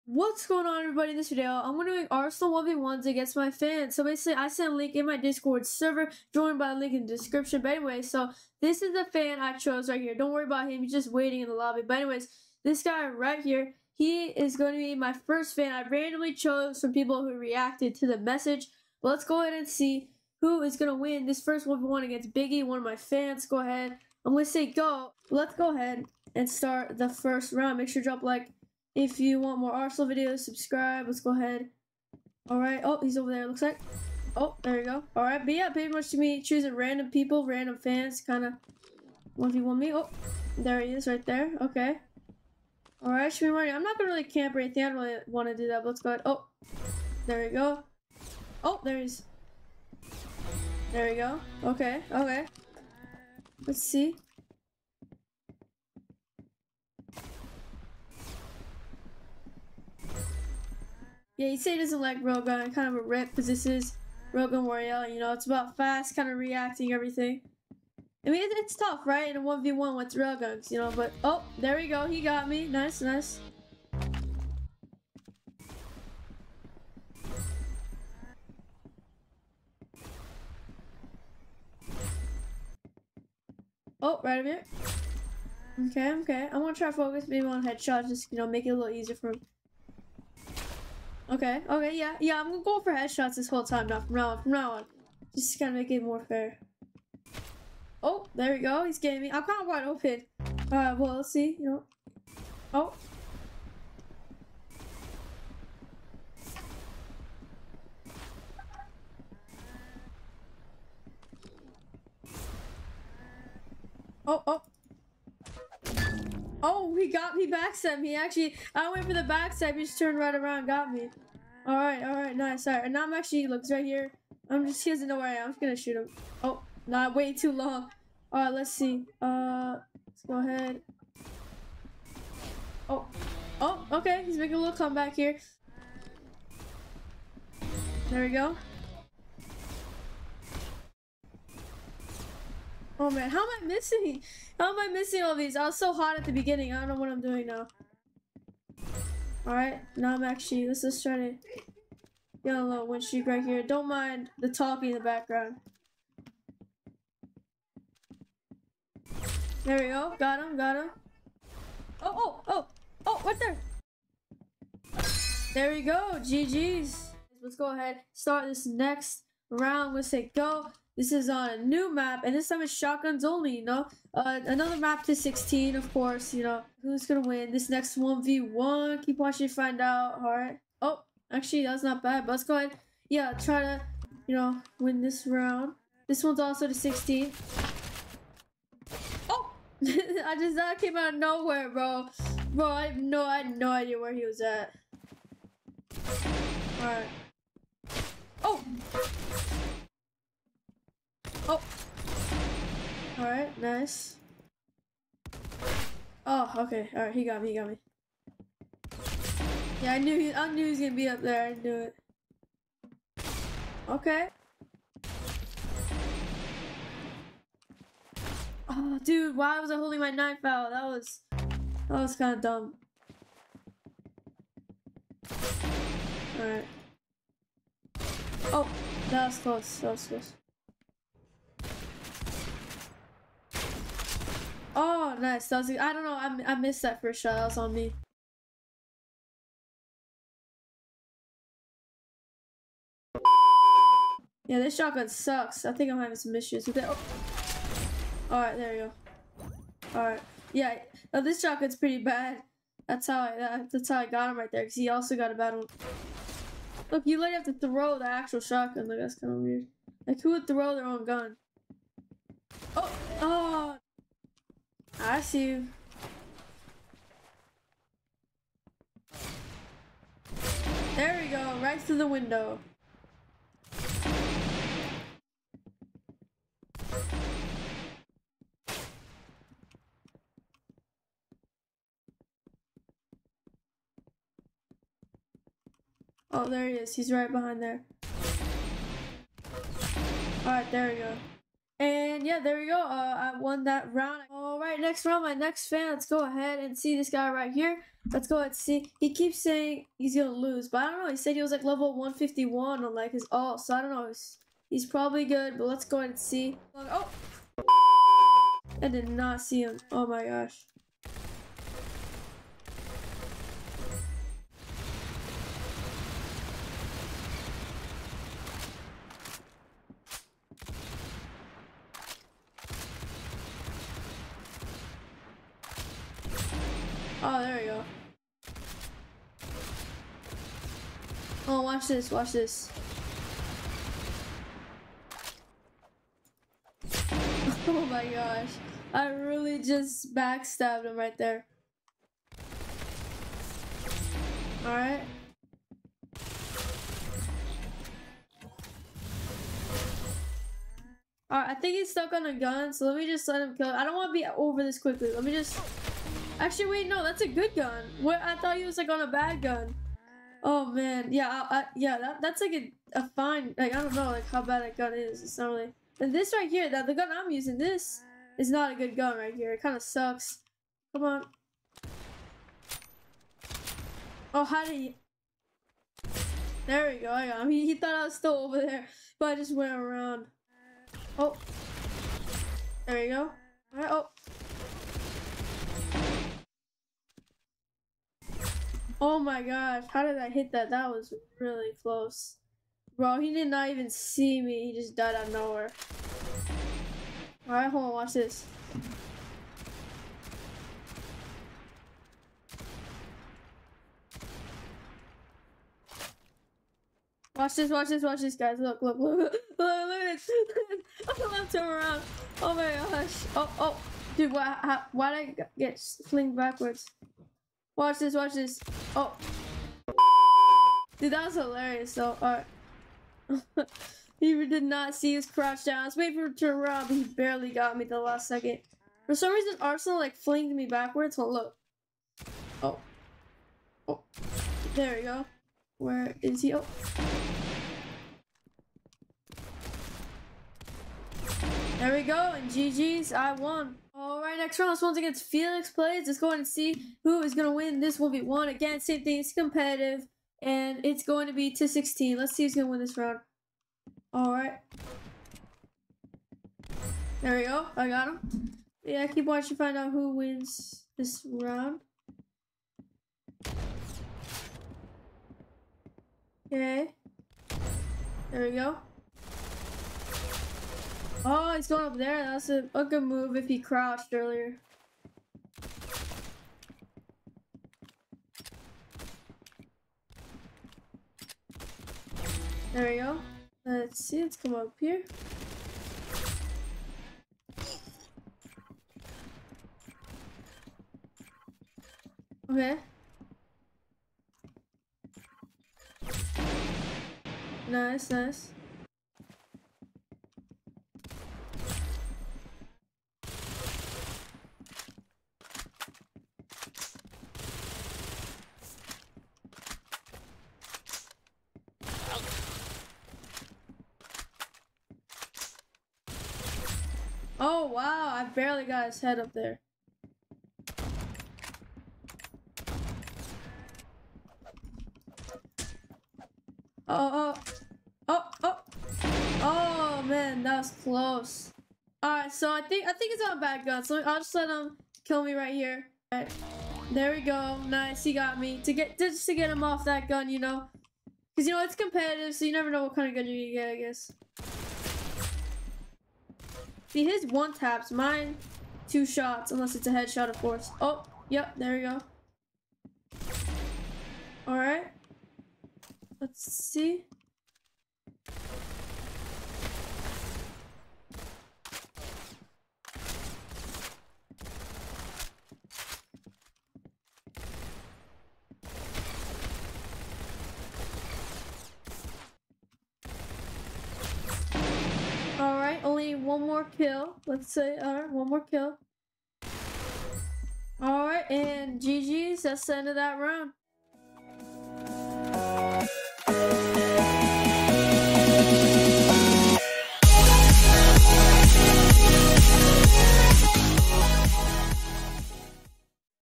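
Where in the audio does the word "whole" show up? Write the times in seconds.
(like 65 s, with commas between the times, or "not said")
93 s.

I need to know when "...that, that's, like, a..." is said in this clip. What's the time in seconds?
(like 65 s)
361 s.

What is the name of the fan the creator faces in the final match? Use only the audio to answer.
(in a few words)
Felix Plays.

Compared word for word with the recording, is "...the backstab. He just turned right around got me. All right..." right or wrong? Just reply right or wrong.
right.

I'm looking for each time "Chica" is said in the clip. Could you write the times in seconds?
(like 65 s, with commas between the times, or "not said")
not said.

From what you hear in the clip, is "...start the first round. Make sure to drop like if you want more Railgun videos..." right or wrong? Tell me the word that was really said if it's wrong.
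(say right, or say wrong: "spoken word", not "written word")
wrong: "Arsenal", not "Railgun".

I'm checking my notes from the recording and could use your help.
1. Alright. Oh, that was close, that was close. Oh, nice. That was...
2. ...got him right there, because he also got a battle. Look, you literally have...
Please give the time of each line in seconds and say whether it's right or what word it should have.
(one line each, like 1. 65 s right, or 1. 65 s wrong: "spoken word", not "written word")
1. 226 s right
2. 254 s right.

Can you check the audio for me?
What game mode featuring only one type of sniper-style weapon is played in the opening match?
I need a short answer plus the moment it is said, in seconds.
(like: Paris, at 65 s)
Railgun Royale, at 64 s.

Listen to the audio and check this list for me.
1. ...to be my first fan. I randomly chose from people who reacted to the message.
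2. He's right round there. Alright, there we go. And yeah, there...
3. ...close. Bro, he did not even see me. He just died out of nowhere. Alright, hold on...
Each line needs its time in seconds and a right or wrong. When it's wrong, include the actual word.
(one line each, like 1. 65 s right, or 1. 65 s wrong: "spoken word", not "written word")
1. 14 s right
2. 286 s wrong: "behind", not "round"
3. 391 s right.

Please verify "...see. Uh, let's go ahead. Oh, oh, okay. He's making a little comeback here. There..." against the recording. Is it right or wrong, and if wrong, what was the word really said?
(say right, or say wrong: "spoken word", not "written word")
right.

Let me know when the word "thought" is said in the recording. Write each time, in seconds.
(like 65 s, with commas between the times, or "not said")
358 s, 377 s.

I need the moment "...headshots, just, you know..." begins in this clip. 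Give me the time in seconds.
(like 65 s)
87 s.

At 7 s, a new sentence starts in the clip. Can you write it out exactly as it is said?
But anyway, so this is the fan I chose right here.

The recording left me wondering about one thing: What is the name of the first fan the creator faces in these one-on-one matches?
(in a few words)
Biggie.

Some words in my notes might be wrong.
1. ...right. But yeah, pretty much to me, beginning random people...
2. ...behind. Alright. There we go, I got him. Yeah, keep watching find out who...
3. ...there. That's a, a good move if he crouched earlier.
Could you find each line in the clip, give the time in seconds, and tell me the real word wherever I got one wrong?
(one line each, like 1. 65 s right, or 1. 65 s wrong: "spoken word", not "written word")
1. 35 s wrong: "choosing", not "beginning"
2. 452 s wrong: "round", not "behind"
3. 471 s right.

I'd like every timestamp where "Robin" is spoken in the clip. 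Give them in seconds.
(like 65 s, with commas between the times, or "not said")
not said.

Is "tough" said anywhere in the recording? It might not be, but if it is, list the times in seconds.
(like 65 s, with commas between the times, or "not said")
68 s.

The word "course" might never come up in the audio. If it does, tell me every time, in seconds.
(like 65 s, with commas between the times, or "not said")
175 s, 550 s.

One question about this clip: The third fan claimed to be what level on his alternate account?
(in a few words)
151.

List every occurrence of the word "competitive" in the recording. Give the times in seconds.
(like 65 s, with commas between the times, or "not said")
449 s, 541 s.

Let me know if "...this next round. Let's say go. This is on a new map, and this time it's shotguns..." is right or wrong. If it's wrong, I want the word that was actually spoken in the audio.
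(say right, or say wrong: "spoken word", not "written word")
right.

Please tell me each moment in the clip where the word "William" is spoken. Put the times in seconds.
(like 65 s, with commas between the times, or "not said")
not said.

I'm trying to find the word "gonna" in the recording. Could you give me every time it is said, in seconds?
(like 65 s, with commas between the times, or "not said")
43 s, 92 s, 125 s, 177 s, 210 s.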